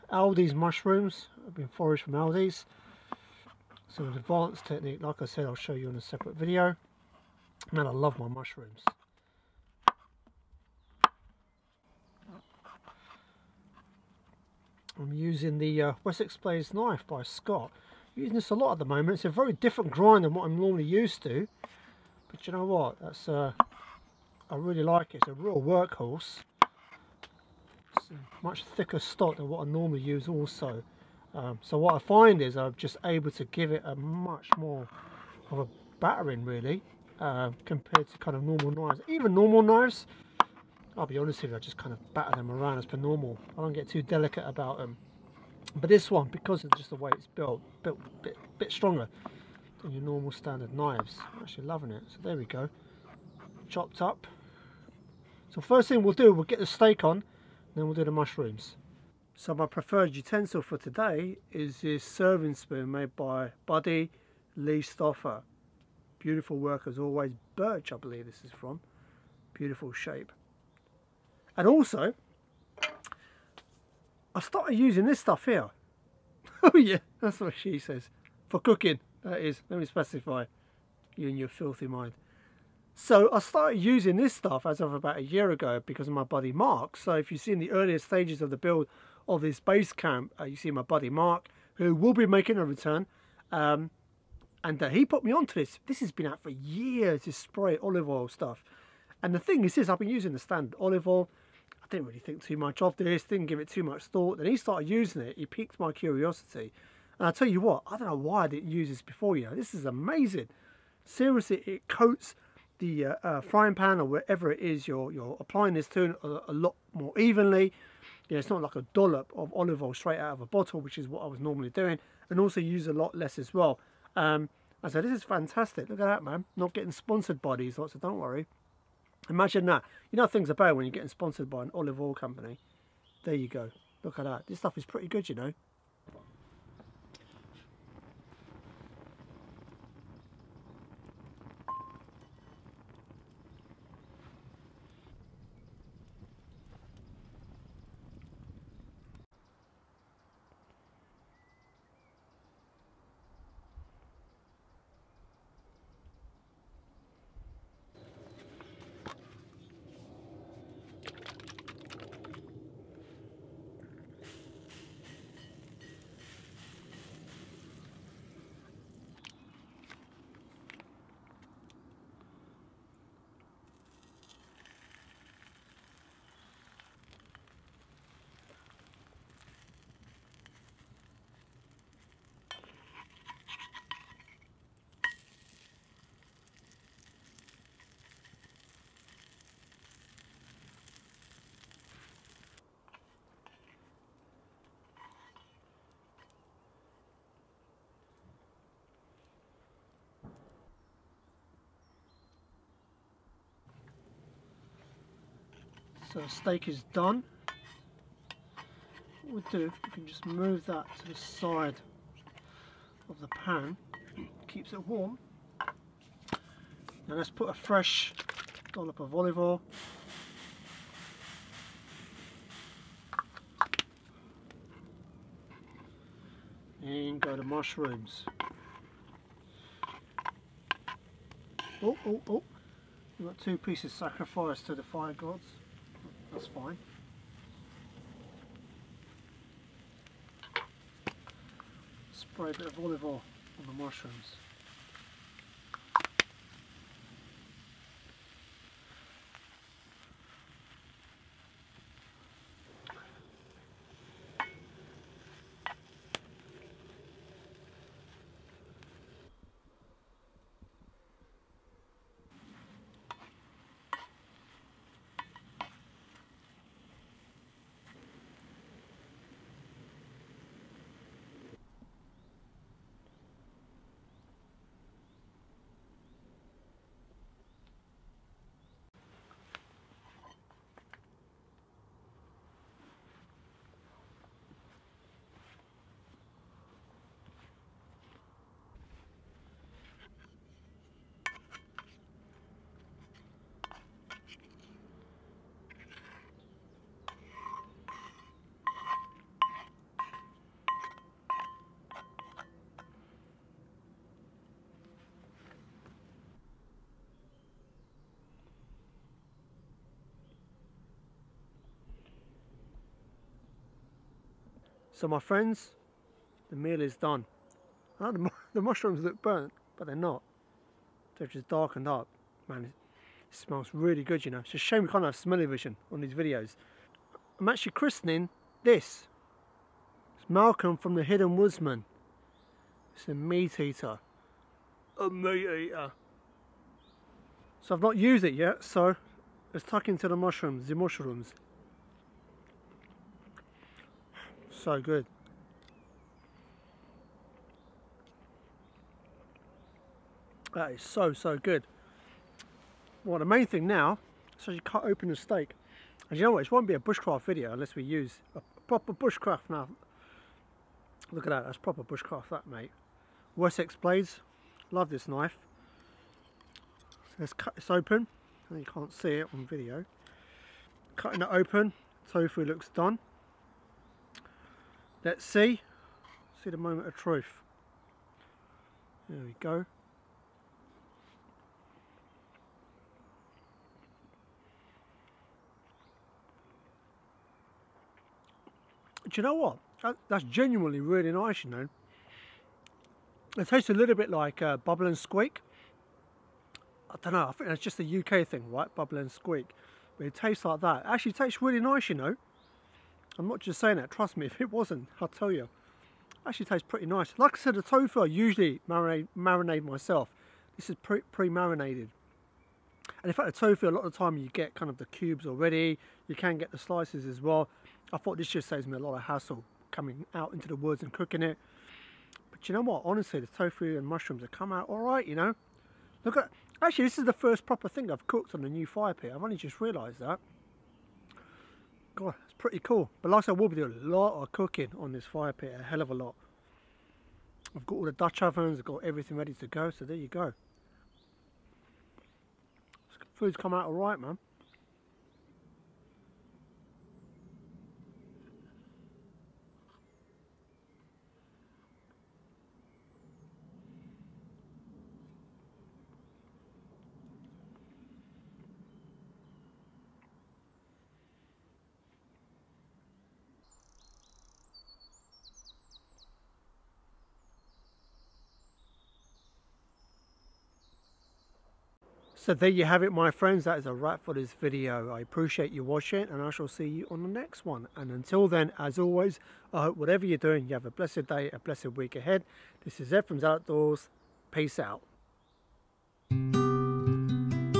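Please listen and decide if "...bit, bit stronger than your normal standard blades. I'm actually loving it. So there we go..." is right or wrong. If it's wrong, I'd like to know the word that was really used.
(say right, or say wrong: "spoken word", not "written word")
wrong: "knives", not "blades".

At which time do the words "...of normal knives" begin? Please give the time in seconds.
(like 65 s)
38 s.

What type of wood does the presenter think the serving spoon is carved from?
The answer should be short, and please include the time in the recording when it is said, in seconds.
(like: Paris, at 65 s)
Birch, at 67 s.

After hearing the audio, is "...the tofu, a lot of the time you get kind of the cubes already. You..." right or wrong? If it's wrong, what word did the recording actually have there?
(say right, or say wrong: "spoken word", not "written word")
right.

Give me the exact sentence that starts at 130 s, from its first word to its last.
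You know things are bad when you're getting sponsored by an olive oil company.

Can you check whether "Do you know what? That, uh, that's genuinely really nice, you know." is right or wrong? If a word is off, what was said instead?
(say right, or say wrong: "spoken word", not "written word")
right.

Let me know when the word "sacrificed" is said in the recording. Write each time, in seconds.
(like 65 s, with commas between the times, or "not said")
233 s.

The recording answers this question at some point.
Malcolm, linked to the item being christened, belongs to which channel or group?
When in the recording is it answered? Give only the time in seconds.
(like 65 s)
330 s.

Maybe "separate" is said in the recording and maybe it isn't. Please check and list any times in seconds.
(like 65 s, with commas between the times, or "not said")
5 s.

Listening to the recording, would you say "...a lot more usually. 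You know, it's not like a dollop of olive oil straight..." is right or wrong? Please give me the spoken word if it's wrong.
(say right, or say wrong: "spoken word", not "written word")
wrong: "evenly", not "usually".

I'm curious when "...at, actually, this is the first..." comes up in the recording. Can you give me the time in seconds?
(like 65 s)
426 s.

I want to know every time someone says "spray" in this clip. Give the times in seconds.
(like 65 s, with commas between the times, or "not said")
97 s, 242 s.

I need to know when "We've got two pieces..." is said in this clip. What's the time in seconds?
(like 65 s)
233 s.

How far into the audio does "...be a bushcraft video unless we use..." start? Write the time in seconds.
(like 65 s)
356 s.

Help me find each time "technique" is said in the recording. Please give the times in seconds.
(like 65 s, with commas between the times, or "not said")
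4 s.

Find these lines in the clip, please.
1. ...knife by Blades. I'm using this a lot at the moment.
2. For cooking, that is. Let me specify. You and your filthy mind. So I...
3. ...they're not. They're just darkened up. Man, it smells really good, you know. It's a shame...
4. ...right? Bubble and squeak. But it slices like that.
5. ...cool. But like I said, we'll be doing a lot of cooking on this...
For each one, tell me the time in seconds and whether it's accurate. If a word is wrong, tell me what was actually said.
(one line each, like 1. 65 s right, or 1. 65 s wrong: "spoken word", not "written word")
1. 16 s wrong: "Scott", not "Blades"
2. 78 s right
3. 319 s right
4. 398 s wrong: "tastes", not "slices"
5. 432 s right.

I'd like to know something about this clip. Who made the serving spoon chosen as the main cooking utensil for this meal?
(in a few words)
Buddy Lee Stoffer.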